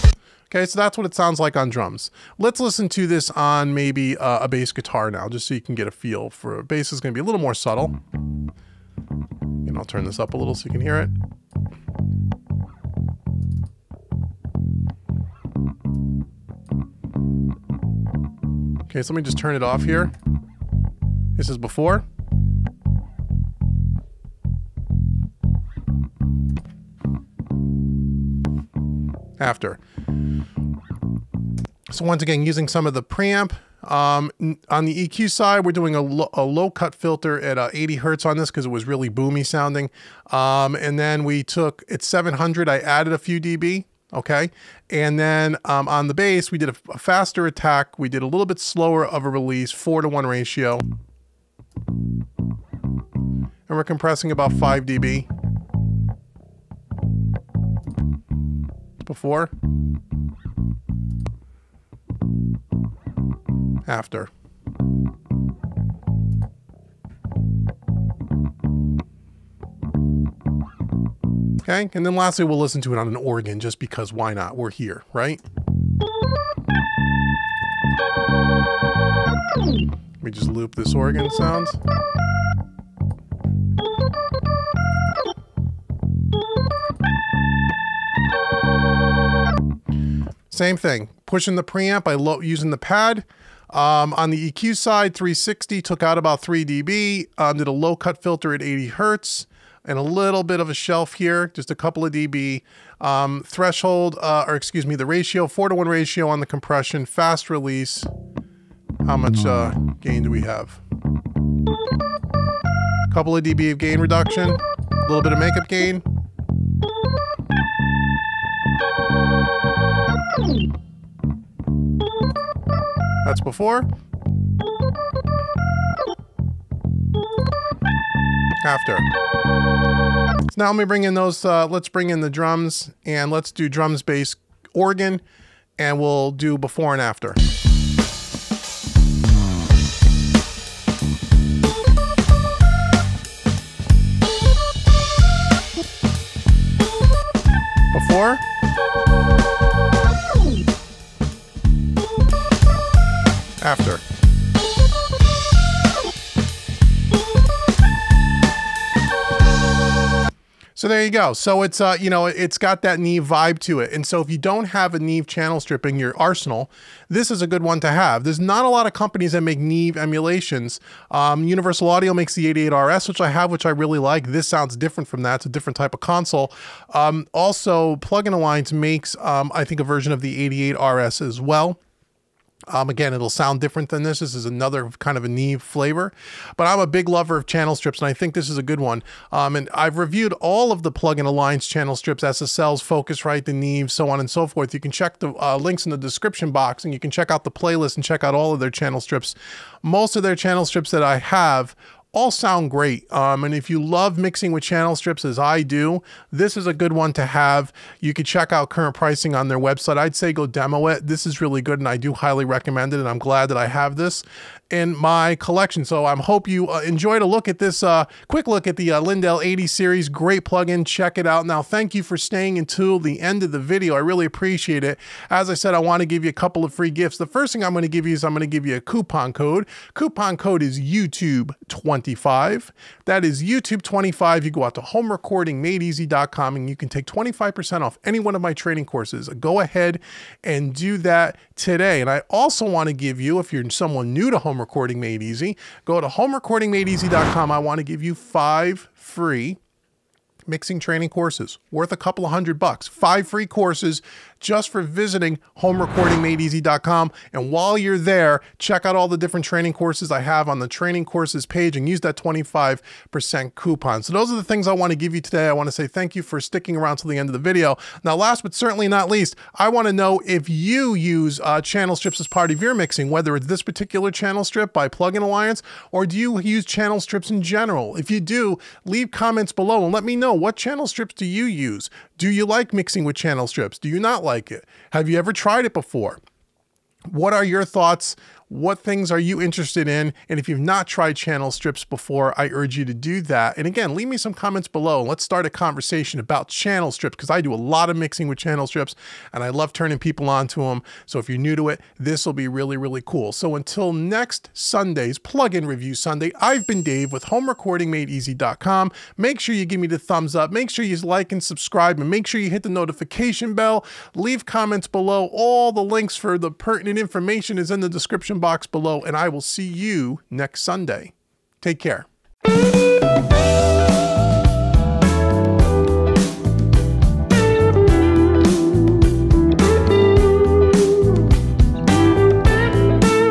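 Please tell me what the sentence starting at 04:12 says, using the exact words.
Five free courses just for visiting homerecordingmadeeasy.com.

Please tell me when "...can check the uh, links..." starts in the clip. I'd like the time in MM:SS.
03:14.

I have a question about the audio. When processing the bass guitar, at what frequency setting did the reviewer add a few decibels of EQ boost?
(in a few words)
700.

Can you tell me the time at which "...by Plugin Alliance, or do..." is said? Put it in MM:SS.
04:34.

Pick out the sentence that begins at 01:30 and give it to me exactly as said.
Same thing, pushing the preamp by using the pad.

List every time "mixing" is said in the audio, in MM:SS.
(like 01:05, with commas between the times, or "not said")
03:24, 04:10, 04:32, 04:42, 04:57.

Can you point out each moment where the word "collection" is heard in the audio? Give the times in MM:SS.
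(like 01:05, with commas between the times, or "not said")
03:35.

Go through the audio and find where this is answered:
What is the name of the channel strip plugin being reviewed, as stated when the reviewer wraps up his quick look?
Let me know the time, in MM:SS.
03:39.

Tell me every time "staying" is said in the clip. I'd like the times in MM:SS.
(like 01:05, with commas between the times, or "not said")
03:42.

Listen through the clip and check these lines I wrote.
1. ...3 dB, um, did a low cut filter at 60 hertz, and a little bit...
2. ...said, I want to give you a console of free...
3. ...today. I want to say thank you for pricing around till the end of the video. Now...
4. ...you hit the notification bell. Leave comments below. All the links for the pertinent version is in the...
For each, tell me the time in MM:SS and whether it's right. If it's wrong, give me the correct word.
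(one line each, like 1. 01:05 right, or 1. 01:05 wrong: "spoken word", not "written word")
1. 01:36 wrong: "80", not "60"
2. 03:45 wrong: "couple", not "console"
3. 04:25 wrong: "sticking", not "pricing"
4. 05:12 wrong: "information", not "version".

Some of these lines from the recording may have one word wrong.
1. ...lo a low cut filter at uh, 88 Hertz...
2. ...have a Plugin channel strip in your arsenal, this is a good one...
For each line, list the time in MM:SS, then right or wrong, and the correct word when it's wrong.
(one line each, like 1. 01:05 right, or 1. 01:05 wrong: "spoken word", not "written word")
1. 00:36 wrong: "80", not "88"
2. 02:44 wrong: "Neve", not "Plugin".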